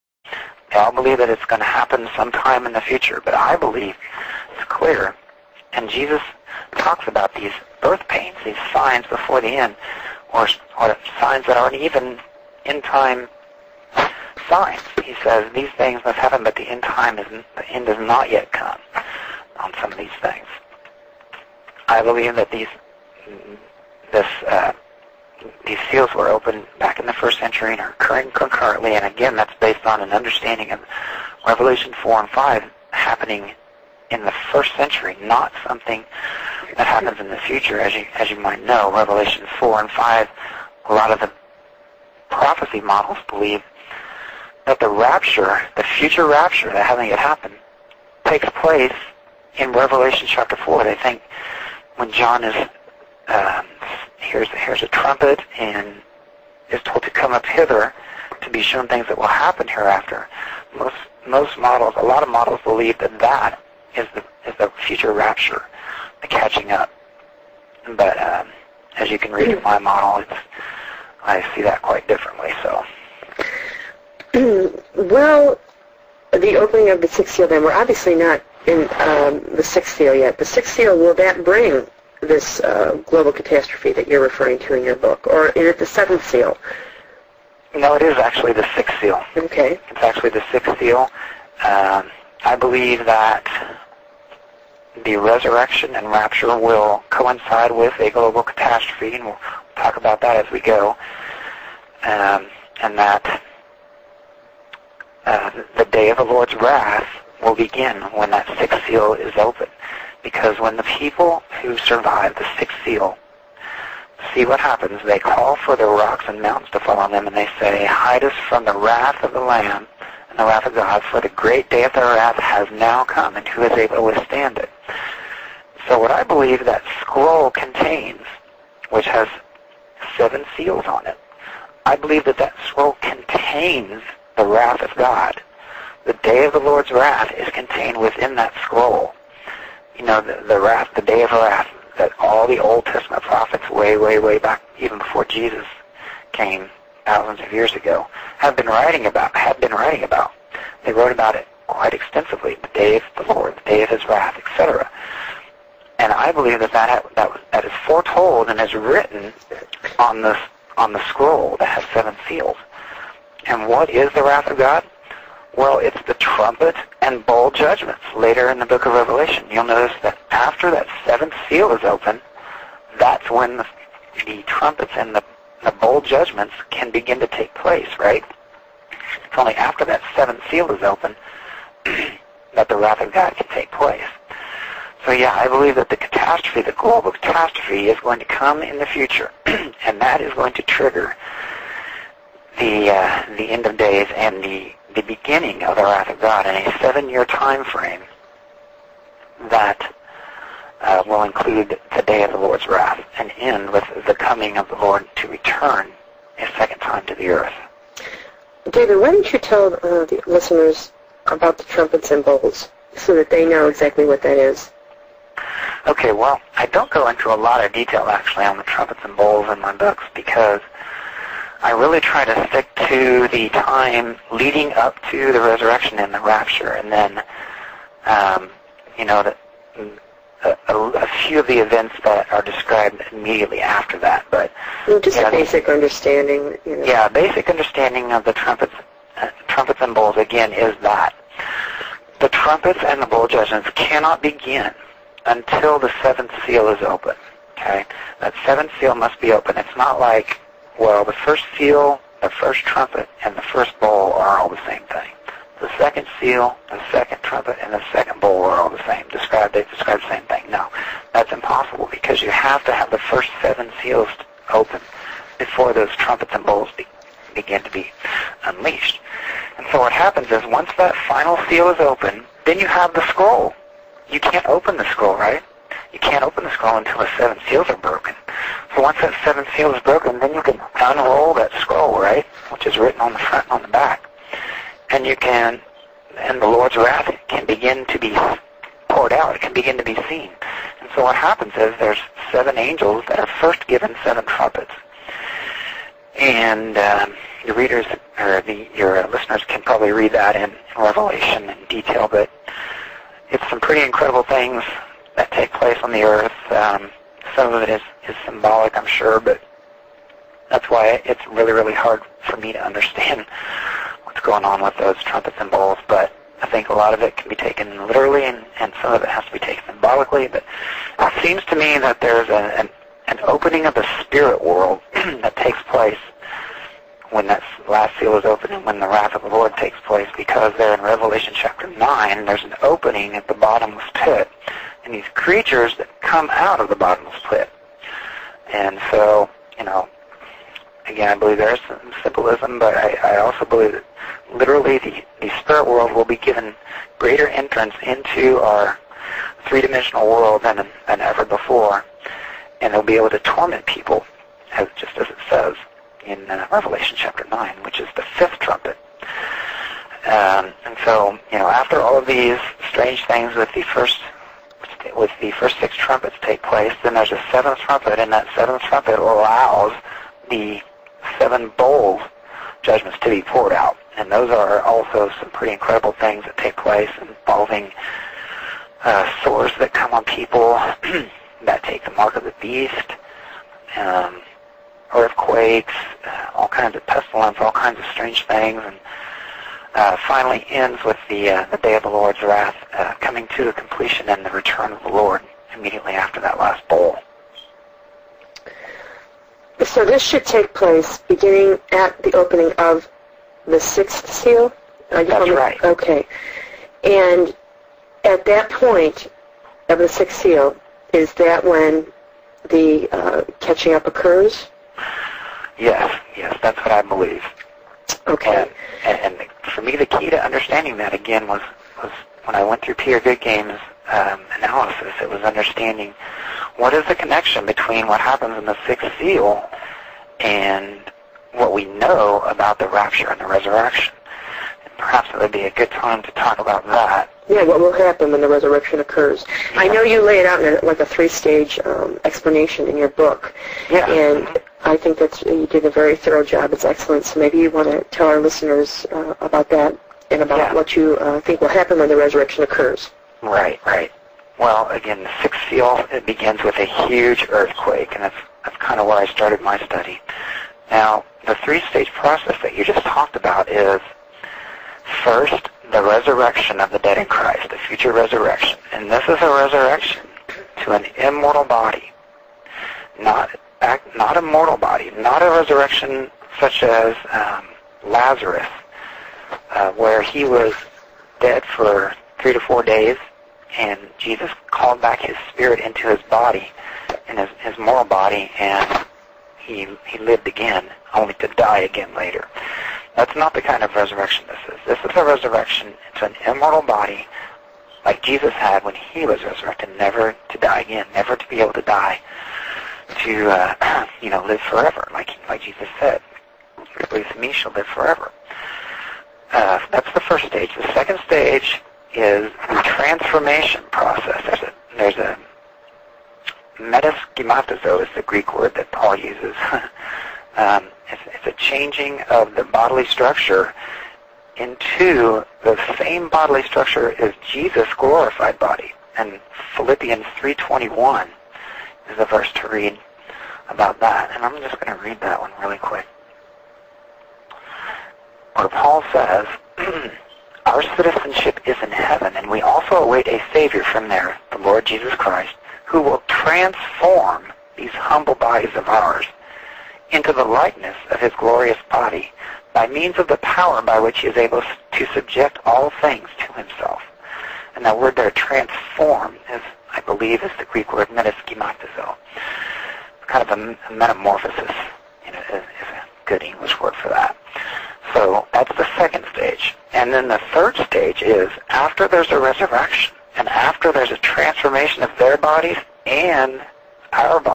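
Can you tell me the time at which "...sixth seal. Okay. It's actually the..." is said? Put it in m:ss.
1:28.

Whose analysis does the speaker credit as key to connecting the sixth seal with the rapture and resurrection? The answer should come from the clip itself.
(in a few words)
Peter Goodgame.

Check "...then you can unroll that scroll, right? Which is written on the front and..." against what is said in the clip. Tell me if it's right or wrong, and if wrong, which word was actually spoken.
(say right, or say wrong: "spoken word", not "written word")
right.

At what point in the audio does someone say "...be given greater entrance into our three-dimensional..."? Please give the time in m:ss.
5:46.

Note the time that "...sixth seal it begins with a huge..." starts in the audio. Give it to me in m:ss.
7:35.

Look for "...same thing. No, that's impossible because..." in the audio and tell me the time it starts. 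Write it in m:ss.
4:20.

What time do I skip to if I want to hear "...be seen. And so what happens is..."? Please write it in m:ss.
4:49.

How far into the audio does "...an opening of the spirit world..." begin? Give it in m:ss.
5:23.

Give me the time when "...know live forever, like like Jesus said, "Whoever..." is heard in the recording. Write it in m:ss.
8:24.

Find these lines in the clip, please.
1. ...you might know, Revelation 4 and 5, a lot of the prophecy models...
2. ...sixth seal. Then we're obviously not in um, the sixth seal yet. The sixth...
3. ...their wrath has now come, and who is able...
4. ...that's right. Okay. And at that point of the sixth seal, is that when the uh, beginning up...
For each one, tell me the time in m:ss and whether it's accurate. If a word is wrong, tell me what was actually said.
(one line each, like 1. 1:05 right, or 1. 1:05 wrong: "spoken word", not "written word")
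1. 0:38 right
2. 1:17 right
3. 2:01 right
4. 6:45 wrong: "catching", not "beginning".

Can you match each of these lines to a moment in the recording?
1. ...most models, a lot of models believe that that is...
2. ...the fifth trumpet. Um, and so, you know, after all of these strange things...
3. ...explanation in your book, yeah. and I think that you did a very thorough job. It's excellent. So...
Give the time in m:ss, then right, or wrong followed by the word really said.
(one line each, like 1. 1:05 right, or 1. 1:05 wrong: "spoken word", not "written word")
1. 1:01 right
2. 5:57 right
3. 7:22 right.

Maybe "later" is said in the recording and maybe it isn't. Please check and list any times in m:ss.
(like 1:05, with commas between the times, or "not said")
2:48, 8:11.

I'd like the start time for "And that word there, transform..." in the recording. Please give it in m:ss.
9:17.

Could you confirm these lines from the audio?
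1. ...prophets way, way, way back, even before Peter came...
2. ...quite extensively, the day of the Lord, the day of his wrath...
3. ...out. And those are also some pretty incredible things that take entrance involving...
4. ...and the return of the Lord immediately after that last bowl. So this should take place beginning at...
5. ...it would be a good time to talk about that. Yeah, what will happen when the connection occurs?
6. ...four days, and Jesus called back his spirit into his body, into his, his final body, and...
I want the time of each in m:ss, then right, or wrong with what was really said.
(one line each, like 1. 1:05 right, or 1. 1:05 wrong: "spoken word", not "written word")
1. 2:23 wrong: "Jesus", not "Peter"
2. 2:31 right
3. 6:13 wrong: "place", not "entrance"
4. 6:34 right
5. 7:15 wrong: "resurrection", not "connection"
6. 8:02 wrong: "moral", not "final".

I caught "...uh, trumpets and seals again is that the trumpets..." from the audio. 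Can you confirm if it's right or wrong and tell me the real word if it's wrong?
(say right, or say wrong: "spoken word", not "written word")
wrong: "bowls", not "seals".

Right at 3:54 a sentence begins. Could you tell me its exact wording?
But just you know, a basic the, understanding.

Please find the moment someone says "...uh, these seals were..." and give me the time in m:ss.
0:24.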